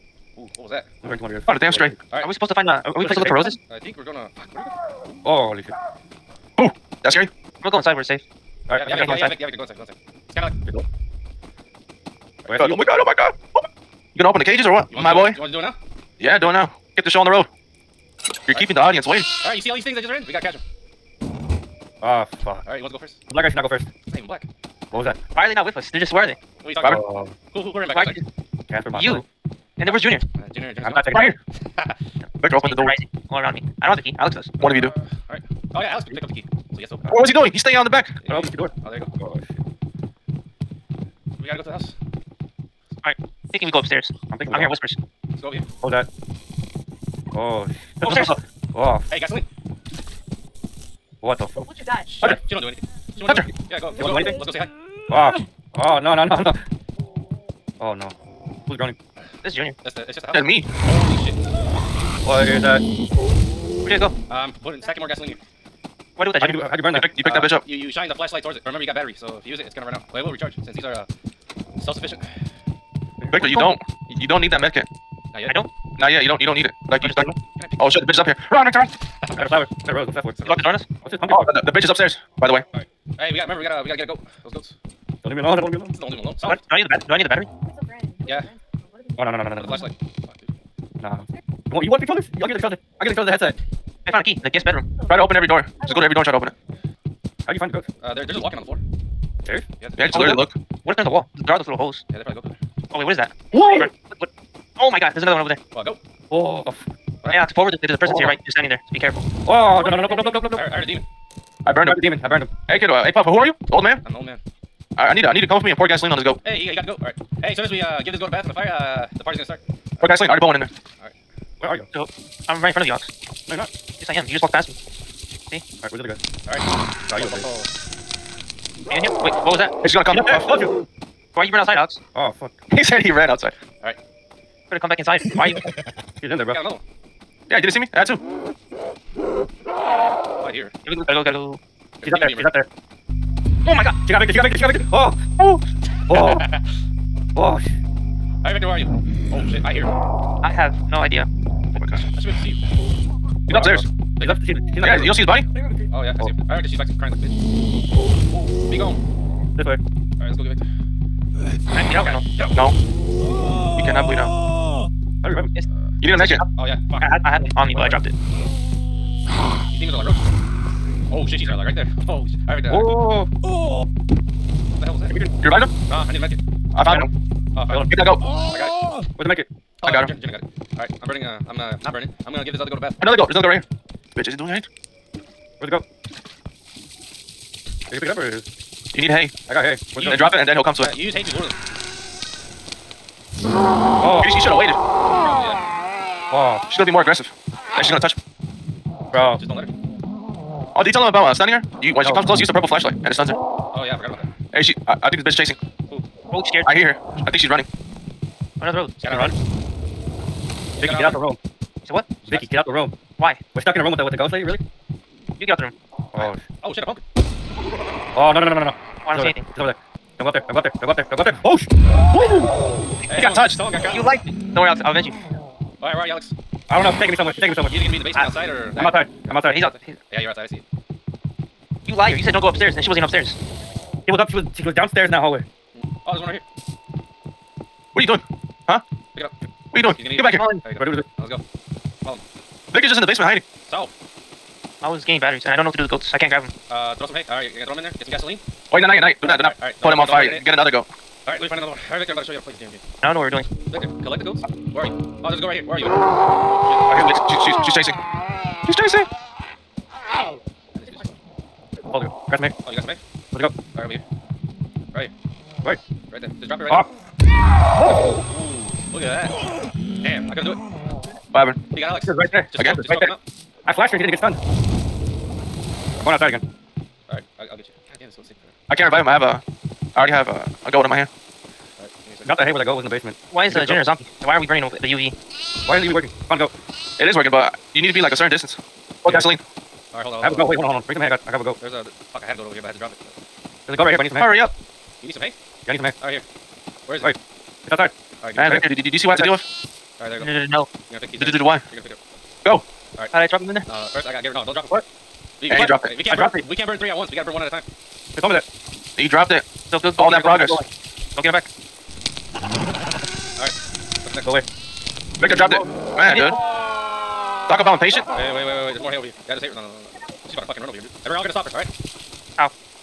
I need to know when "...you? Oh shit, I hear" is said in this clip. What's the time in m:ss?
2:28.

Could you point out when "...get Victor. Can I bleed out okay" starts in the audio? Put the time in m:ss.
2:40.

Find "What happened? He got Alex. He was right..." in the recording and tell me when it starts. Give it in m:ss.
4:31.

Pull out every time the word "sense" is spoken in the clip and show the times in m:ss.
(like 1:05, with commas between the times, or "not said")
not said.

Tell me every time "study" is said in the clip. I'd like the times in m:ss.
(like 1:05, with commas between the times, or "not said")
not said.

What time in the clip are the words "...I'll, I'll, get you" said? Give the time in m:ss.
4:37.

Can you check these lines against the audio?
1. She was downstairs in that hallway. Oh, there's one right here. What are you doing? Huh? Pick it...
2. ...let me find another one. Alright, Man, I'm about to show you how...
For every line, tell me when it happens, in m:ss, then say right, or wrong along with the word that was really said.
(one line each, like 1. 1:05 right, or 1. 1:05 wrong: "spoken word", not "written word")
1. 3:54 right
2. 4:11 wrong: "Victor", not "Man".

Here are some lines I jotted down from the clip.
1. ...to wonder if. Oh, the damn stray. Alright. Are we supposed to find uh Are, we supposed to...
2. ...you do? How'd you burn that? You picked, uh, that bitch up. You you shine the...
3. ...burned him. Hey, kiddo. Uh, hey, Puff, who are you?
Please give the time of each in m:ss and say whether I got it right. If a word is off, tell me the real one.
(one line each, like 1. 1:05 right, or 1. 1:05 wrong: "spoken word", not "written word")
1. 0:01 right
2. 1:06 right
3. 1:52 right.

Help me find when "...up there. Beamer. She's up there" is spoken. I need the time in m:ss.
2:22.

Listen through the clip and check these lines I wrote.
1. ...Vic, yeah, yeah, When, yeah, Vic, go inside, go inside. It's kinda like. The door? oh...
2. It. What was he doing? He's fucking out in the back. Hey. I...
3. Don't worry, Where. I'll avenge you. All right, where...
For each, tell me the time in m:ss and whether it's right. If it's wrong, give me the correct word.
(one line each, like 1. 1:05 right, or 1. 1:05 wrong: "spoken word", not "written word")
1. 0:08 wrong: "Vic", not "When"
2. 0:37 wrong: "staying", not "fucking"
3. 3:44 wrong: "Alex", not "Where".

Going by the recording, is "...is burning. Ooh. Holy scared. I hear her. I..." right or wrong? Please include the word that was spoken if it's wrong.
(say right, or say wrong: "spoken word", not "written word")
wrong: "chasing", not "burning".